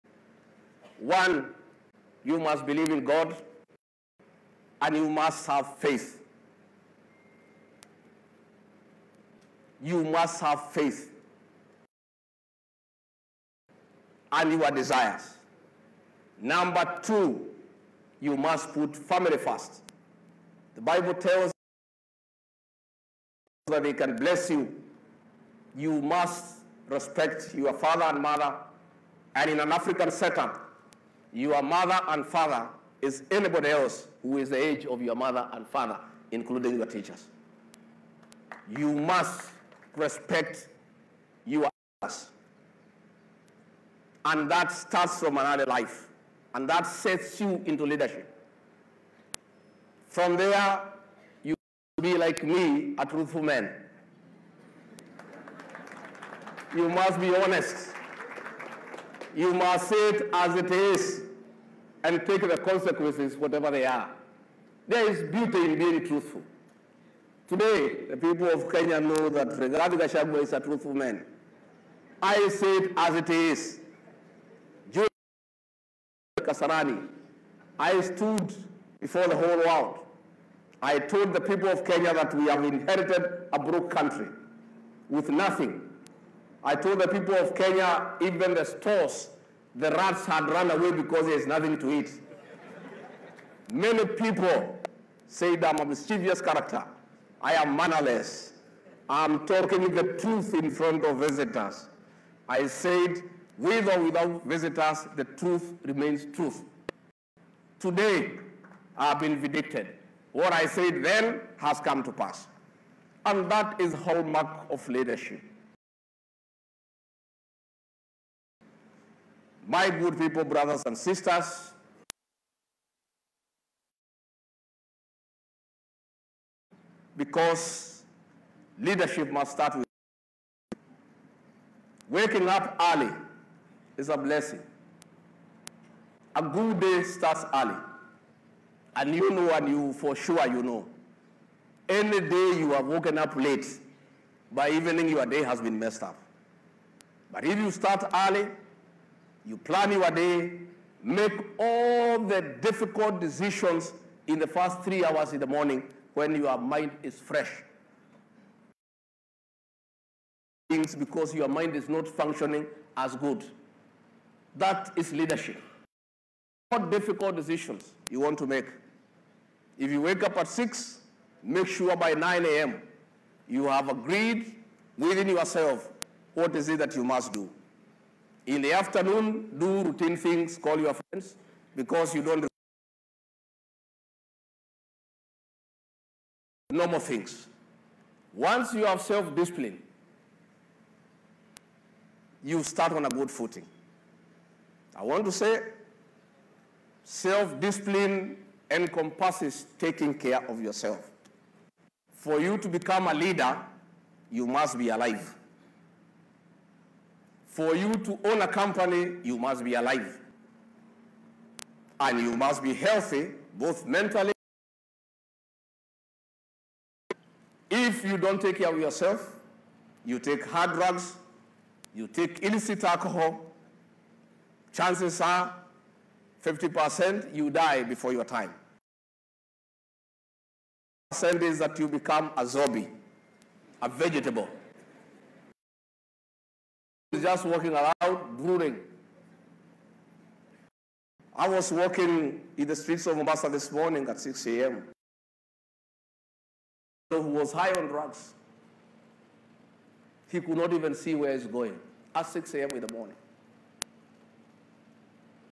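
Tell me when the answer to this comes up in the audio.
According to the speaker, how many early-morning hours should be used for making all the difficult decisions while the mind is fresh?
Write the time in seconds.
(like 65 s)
154 s.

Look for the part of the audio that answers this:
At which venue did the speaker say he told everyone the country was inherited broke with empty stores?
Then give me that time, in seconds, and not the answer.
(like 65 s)
76 s.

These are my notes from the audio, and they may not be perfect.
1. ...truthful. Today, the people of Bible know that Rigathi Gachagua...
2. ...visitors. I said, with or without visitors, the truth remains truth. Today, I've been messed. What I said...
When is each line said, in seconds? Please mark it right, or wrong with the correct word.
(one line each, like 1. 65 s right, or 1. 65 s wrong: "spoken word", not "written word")
1. 66 s wrong: "Kenya", not "Bible"
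2. 101 s wrong: "vindicated", not "messed".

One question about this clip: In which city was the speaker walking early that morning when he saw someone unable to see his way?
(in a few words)
Mombasa.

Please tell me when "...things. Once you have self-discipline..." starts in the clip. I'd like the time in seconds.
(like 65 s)
186 s.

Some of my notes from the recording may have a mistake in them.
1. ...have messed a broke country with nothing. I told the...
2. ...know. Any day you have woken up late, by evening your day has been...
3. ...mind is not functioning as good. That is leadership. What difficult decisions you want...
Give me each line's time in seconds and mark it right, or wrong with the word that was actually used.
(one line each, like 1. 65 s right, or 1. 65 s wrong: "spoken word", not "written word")
1. 82 s wrong: "inherited", not "messed"
2. 140 s right
3. 161 s right.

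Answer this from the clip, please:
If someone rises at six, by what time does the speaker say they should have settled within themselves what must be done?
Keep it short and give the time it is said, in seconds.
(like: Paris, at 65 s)
9 a.m., at 172 s.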